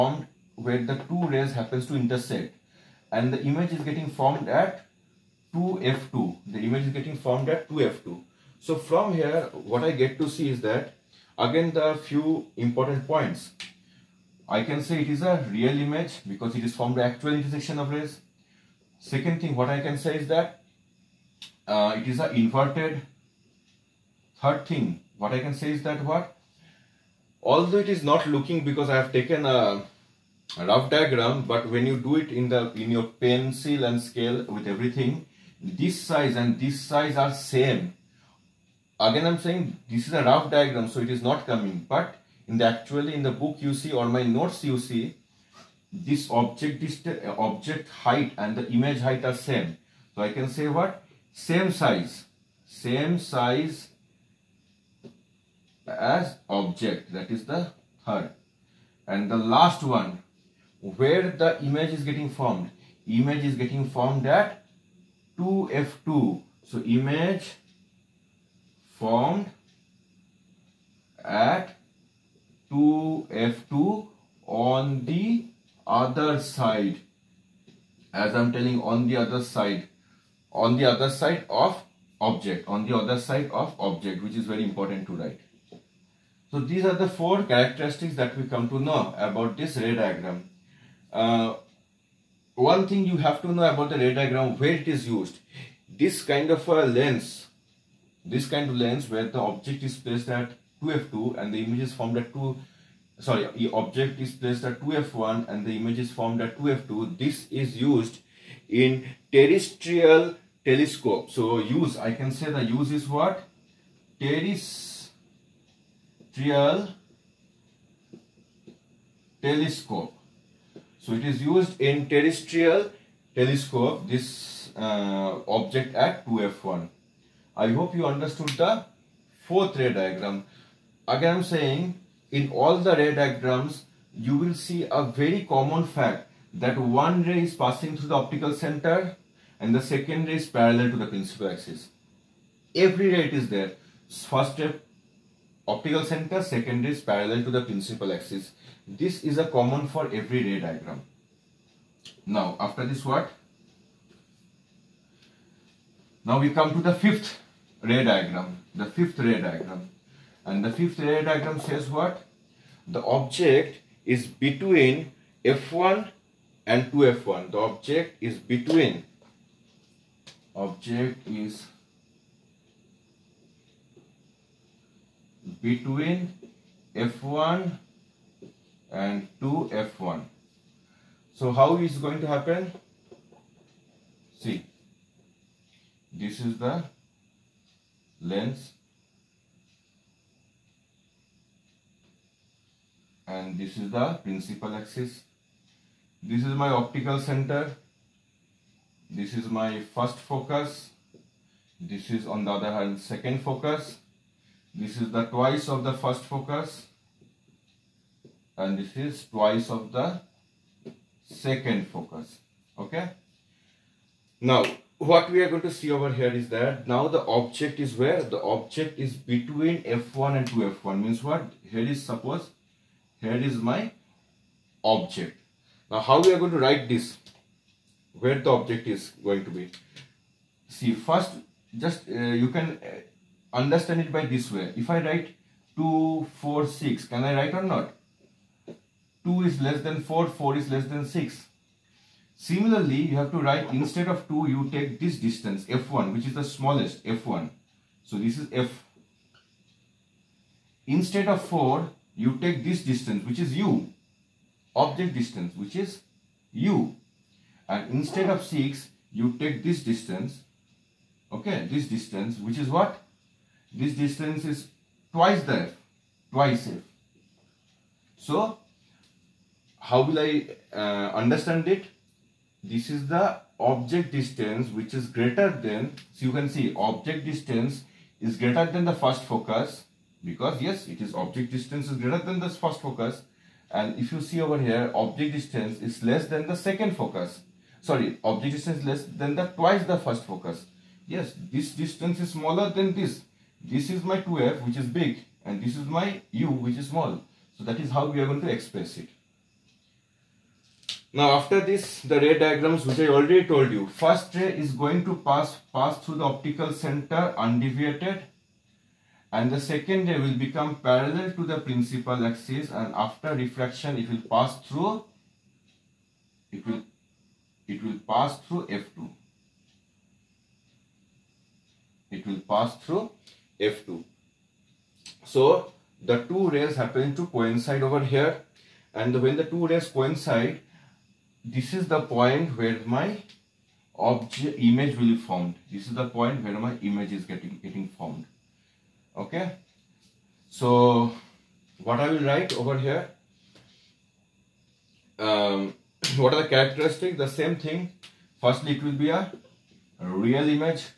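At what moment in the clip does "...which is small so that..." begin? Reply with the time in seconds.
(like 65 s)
296 s.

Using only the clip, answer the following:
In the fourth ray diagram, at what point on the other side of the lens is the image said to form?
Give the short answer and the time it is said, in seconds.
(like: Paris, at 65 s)
2F2, at 71 s.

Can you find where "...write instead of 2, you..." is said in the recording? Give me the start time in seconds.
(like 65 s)
243 s.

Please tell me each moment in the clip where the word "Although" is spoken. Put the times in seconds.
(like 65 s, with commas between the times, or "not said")
27 s.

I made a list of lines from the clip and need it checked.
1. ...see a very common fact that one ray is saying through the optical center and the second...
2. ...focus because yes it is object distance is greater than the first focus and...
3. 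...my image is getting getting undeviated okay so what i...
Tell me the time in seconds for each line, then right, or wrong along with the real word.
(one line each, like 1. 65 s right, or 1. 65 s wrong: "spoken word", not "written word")
1. 134 s wrong: "passing", not "saying"
2. 279 s right
3. 336 s wrong: "formed", not "undeviated".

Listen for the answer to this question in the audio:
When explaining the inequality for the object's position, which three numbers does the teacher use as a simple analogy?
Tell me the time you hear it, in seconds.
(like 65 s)
235 s.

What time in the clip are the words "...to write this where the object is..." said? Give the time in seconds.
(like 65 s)
226 s.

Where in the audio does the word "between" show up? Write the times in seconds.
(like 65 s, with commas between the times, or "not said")
164 s, 168 s, 175 s, 219 s.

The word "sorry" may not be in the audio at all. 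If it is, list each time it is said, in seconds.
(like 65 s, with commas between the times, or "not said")
103 s, 287 s.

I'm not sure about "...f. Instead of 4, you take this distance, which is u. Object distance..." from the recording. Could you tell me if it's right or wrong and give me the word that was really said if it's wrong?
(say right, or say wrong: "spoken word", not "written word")
right.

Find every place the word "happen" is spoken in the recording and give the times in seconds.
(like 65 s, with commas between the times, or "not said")
1 s, 182 s, 326 s.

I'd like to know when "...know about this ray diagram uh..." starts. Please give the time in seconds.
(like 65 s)
88 s.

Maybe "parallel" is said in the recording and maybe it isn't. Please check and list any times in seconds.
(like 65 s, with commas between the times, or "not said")
140 s, 147 s, 310 s.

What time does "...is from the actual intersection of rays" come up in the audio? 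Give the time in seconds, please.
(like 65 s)
16 s.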